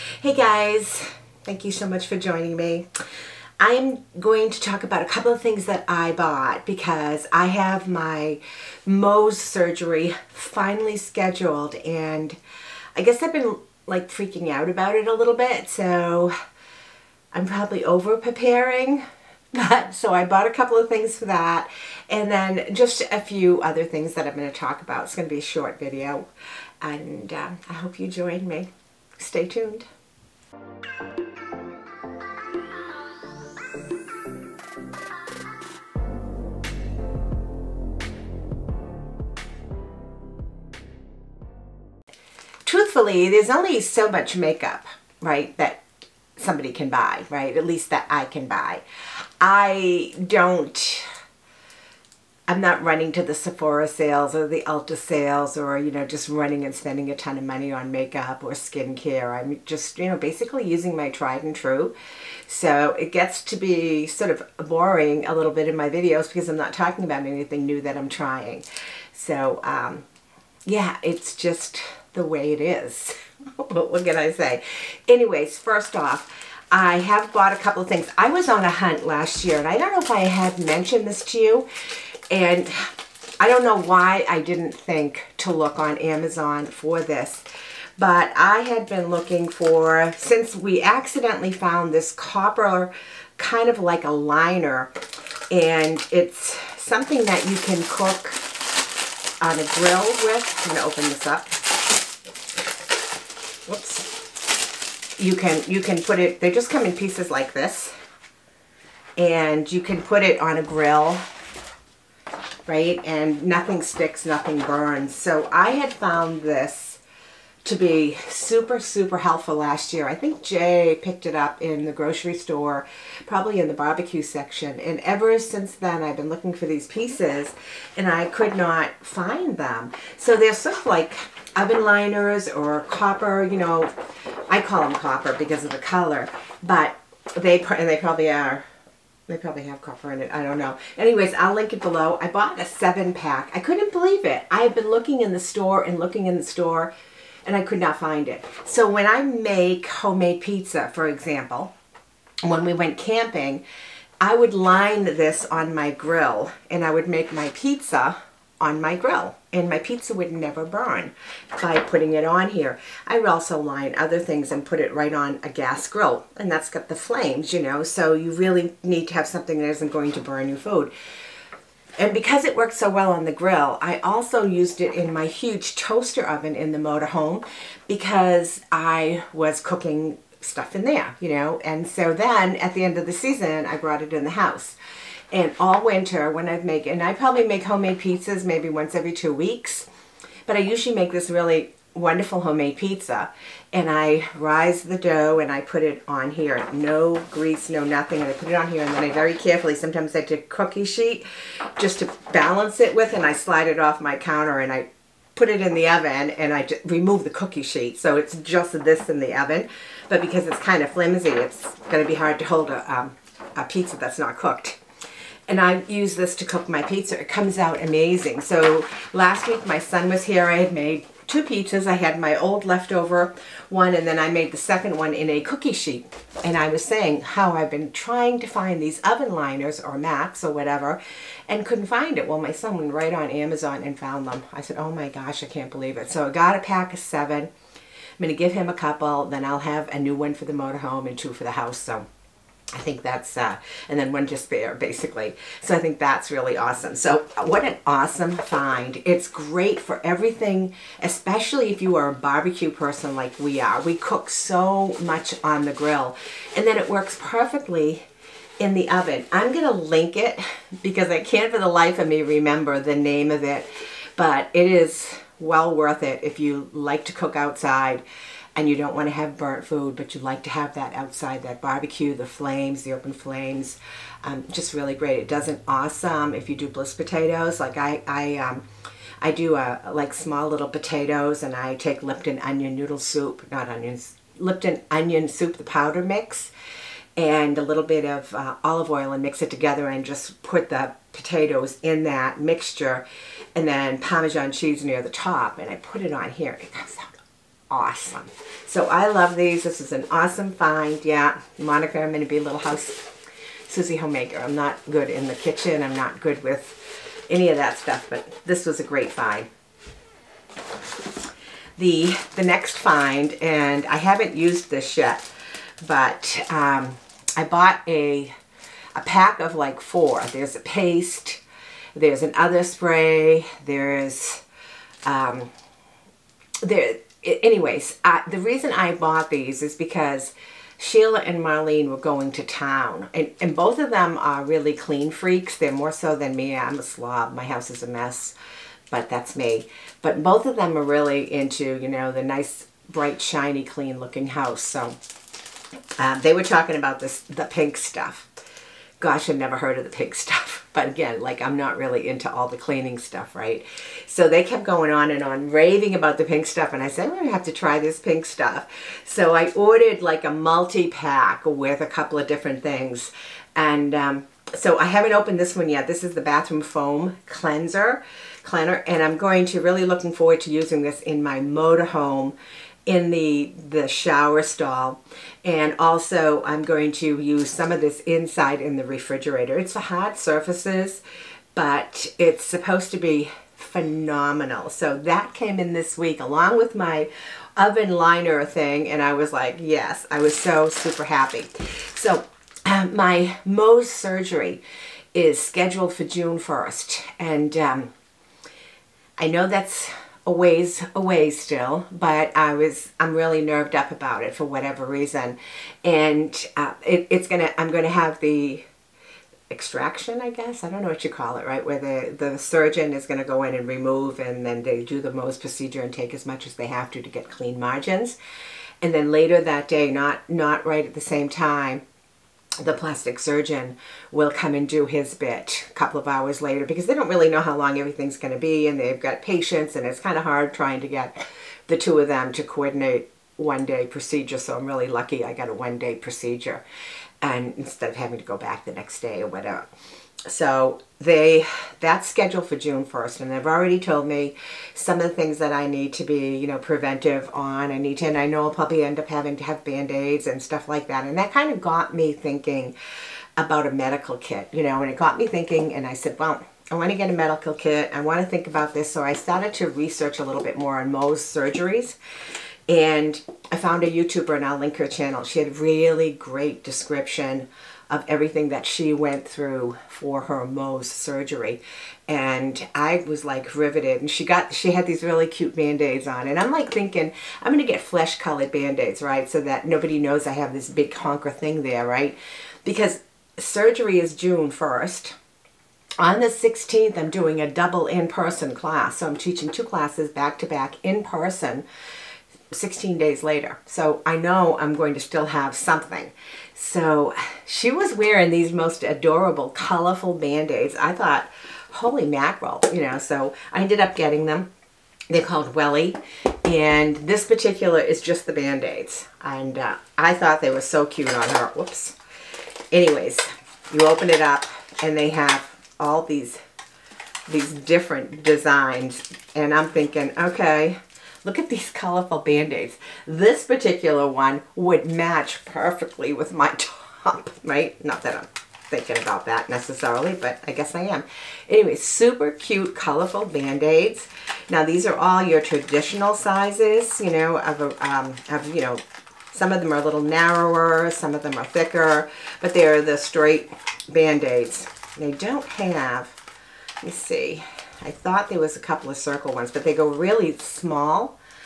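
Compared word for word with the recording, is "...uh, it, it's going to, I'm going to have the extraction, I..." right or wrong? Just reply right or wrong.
right.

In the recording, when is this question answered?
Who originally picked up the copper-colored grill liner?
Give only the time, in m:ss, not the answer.
2:00.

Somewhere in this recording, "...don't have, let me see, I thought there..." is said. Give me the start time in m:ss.
9:05.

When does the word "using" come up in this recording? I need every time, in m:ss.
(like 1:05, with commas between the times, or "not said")
1:00, 6:10.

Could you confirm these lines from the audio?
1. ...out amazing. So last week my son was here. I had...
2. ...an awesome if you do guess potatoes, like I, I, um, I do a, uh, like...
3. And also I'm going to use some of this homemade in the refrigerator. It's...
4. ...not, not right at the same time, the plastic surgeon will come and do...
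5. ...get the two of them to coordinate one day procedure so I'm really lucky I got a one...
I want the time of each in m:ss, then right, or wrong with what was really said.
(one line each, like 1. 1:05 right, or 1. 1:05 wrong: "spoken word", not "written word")
1. 3:37 right
2. 4:35 wrong: "bliss", not "guess"
3. 6:15 wrong: "inside", not "homemade"
4. 6:59 right
5. 7:10 right.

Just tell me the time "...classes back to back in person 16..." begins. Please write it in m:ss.
8:09.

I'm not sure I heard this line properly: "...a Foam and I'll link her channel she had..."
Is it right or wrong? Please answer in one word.
wrong.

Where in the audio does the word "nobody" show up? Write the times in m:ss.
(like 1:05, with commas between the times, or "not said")
7:59.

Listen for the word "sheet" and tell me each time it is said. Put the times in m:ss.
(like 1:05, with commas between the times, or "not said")
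3:20, 3:27, 3:45.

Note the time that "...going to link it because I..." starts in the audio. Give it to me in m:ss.
4:19.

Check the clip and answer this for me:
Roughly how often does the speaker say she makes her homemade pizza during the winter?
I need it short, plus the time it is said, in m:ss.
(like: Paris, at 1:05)
Once every two weeks, at 3:08.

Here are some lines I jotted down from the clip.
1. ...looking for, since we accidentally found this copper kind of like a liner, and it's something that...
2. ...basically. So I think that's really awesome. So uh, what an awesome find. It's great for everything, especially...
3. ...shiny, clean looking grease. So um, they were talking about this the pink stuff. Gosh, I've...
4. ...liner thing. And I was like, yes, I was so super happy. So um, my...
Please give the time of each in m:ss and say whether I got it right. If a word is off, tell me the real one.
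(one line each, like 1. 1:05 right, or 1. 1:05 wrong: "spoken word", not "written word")
1. 1:29 right
2. 4:04 right
3. 5:43 wrong: "house", not "grease"
4. 6:27 right.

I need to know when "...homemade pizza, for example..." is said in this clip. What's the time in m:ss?
2:29.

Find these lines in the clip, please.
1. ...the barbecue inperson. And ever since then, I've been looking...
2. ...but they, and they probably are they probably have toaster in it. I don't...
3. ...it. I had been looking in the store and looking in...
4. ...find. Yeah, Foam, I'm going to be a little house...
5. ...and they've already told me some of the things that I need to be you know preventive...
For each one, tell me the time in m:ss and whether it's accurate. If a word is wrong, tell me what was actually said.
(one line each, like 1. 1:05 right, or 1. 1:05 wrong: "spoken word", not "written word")
1. 2:03 wrong: "section", not "inperson"
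2. 2:16 wrong: "copper", not "toaster"
3. 2:24 right
4. 5:00 wrong: "Monika", not "Foam"
5. 7:23 right.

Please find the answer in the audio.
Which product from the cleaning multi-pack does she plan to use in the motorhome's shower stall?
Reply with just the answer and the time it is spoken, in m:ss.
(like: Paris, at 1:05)
Bathroom Foam Cleanser, at 6:06.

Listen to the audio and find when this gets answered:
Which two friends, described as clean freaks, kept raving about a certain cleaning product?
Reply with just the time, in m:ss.
5:30.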